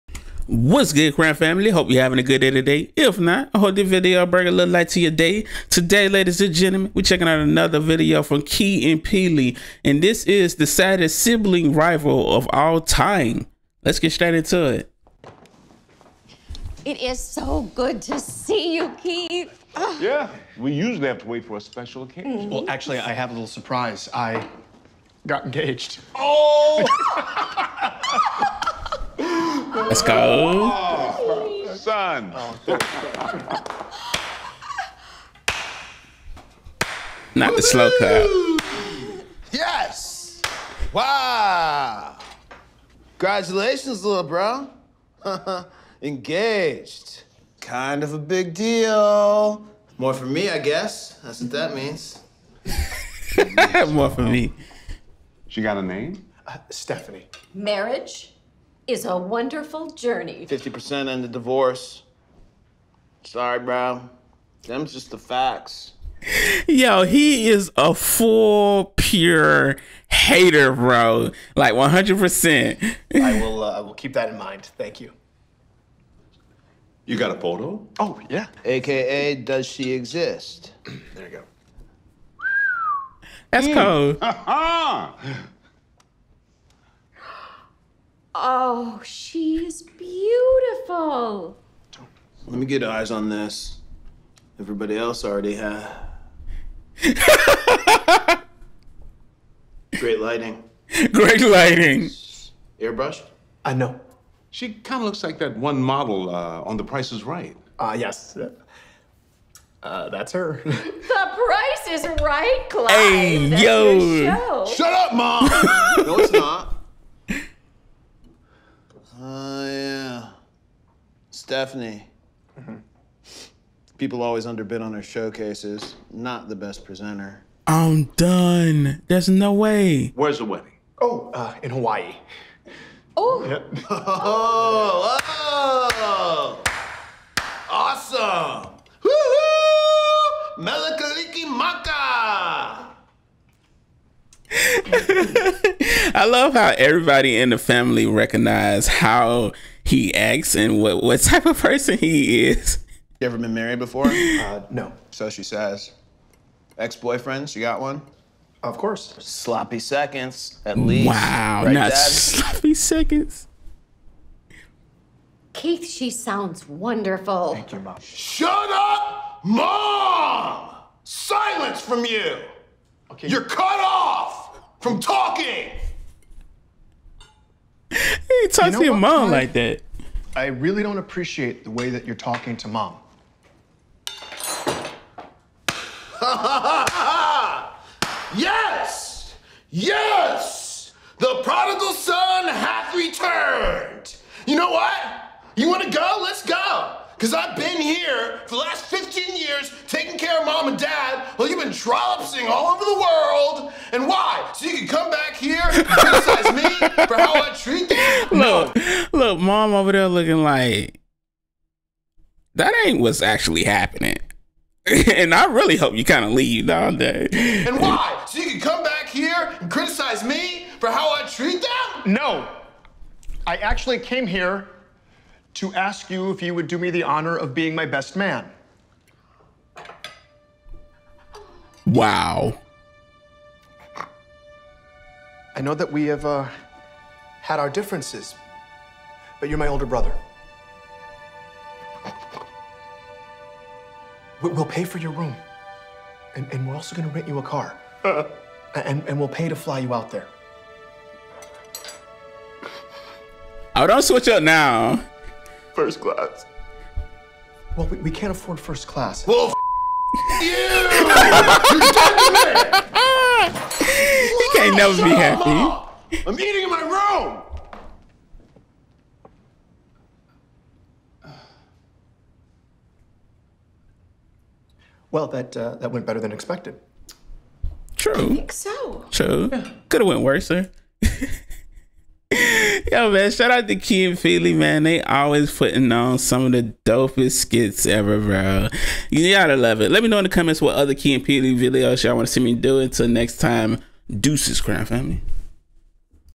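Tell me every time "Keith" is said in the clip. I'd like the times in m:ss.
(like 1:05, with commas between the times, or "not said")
0:19, 2:45.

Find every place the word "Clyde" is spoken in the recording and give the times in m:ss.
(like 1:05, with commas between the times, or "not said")
1:52, 2:59.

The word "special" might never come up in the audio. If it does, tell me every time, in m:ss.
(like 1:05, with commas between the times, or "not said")
0:21.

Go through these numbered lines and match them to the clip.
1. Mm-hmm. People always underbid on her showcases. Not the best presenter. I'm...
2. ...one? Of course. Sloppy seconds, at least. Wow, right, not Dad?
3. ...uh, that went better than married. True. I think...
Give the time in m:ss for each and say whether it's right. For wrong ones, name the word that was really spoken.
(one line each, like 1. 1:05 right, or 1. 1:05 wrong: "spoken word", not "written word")
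1. 2:02 right
2. 2:37 right
3. 4:35 wrong: "expected", not "married".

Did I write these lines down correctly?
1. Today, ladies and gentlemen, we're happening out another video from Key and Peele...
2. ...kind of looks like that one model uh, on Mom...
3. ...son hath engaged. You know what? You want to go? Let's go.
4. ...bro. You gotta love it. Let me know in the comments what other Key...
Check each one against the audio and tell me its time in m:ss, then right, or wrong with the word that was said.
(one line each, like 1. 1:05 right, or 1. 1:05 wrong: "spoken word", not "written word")
1. 0:05 wrong: "checking", not "happening"
2. 1:44 wrong: "The", not "Mom"
3. 3:11 wrong: "returned", not "engaged"
4. 4:48 right.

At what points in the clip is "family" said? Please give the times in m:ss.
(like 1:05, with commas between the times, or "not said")
0:01, 2:27, 4:54.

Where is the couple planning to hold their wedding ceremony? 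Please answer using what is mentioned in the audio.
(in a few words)
Hawaii.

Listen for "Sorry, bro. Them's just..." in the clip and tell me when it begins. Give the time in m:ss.
1:03.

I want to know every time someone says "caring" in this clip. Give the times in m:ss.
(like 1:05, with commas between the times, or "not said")
not said.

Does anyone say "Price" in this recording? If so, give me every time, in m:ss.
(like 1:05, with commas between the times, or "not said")
1:46, 1:51.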